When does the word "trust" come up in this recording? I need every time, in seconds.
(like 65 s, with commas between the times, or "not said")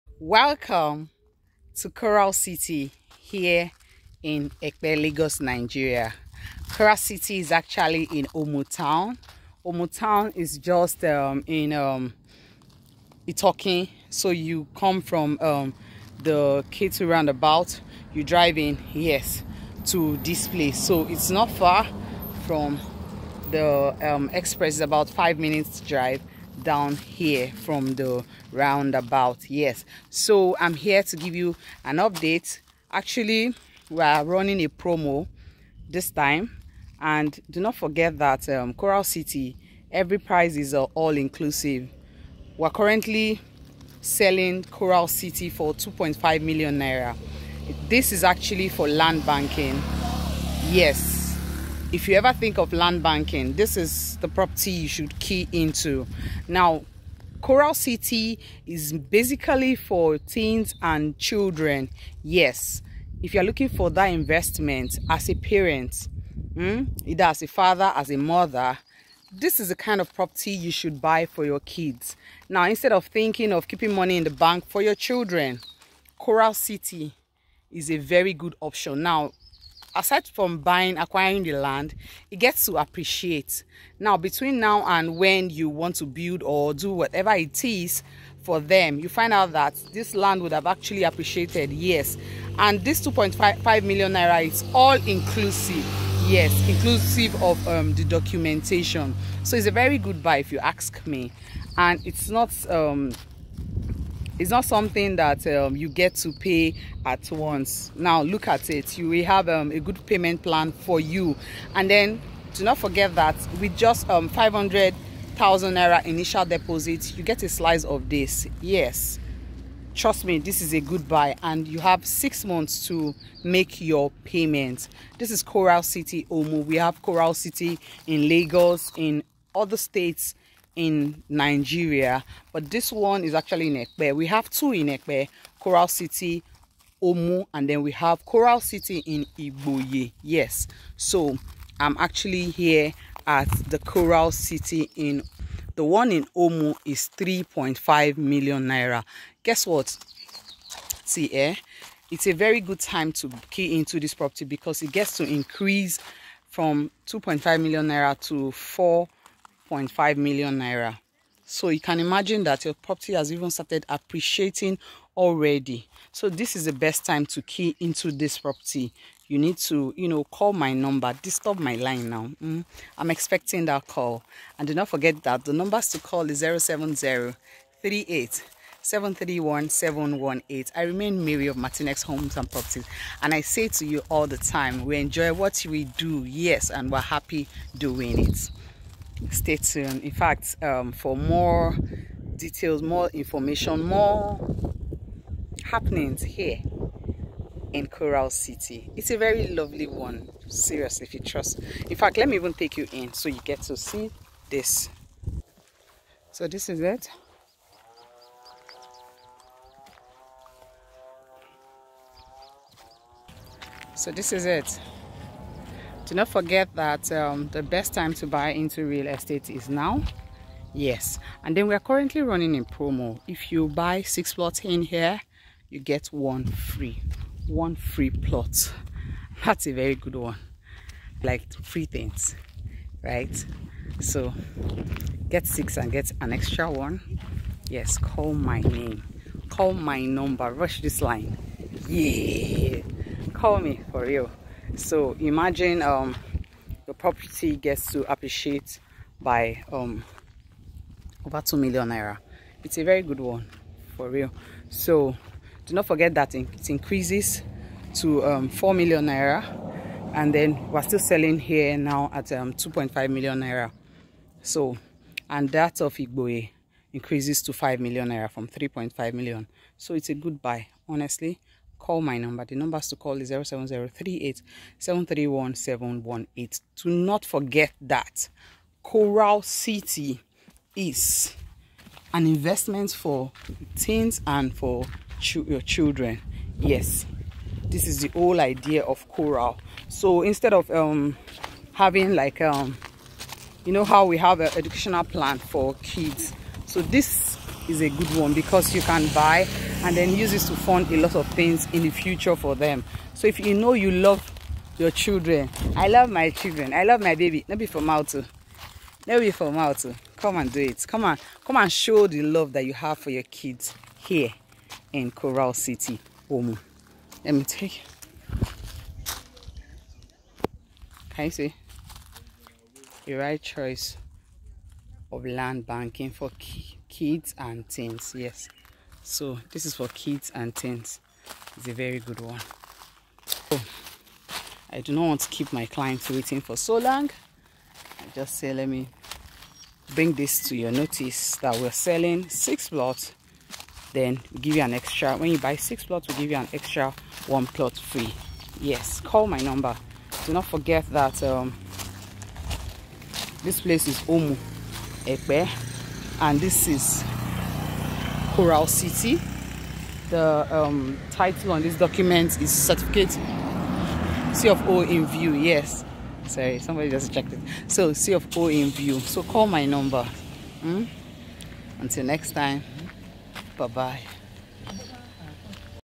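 119 s, 201 s.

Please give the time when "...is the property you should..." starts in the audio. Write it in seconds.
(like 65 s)
53 s.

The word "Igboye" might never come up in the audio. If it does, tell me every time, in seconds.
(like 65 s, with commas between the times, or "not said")
139 s, 265 s.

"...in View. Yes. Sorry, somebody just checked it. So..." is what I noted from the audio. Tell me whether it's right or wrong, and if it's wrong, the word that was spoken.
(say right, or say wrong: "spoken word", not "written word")
right.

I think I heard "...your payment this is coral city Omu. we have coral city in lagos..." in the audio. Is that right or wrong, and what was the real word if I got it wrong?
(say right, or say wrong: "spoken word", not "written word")
right.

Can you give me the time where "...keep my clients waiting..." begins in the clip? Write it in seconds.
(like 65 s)
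335 s.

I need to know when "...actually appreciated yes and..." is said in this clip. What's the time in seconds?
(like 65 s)
90 s.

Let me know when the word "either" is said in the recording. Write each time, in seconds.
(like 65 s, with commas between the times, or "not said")
67 s.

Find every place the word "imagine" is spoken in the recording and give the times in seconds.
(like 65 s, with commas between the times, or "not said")
161 s, 245 s.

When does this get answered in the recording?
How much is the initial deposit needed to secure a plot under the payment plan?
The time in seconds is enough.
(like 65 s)
114 s.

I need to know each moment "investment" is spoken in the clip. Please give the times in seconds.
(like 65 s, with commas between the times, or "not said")
64 s, 282 s.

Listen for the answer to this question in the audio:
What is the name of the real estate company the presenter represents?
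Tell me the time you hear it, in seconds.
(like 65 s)
181 s.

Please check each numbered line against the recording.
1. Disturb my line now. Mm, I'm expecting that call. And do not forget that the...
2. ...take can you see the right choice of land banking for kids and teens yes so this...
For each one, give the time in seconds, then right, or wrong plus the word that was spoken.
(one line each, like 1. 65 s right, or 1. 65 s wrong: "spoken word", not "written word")
1. 171 s right
2. 317 s right.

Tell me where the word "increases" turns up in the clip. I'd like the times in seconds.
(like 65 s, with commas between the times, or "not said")
155 s, 256 s, 266 s.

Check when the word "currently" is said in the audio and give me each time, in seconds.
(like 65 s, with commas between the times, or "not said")
42 s, 221 s.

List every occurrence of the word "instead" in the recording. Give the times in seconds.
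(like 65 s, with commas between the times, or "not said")
72 s, 290 s.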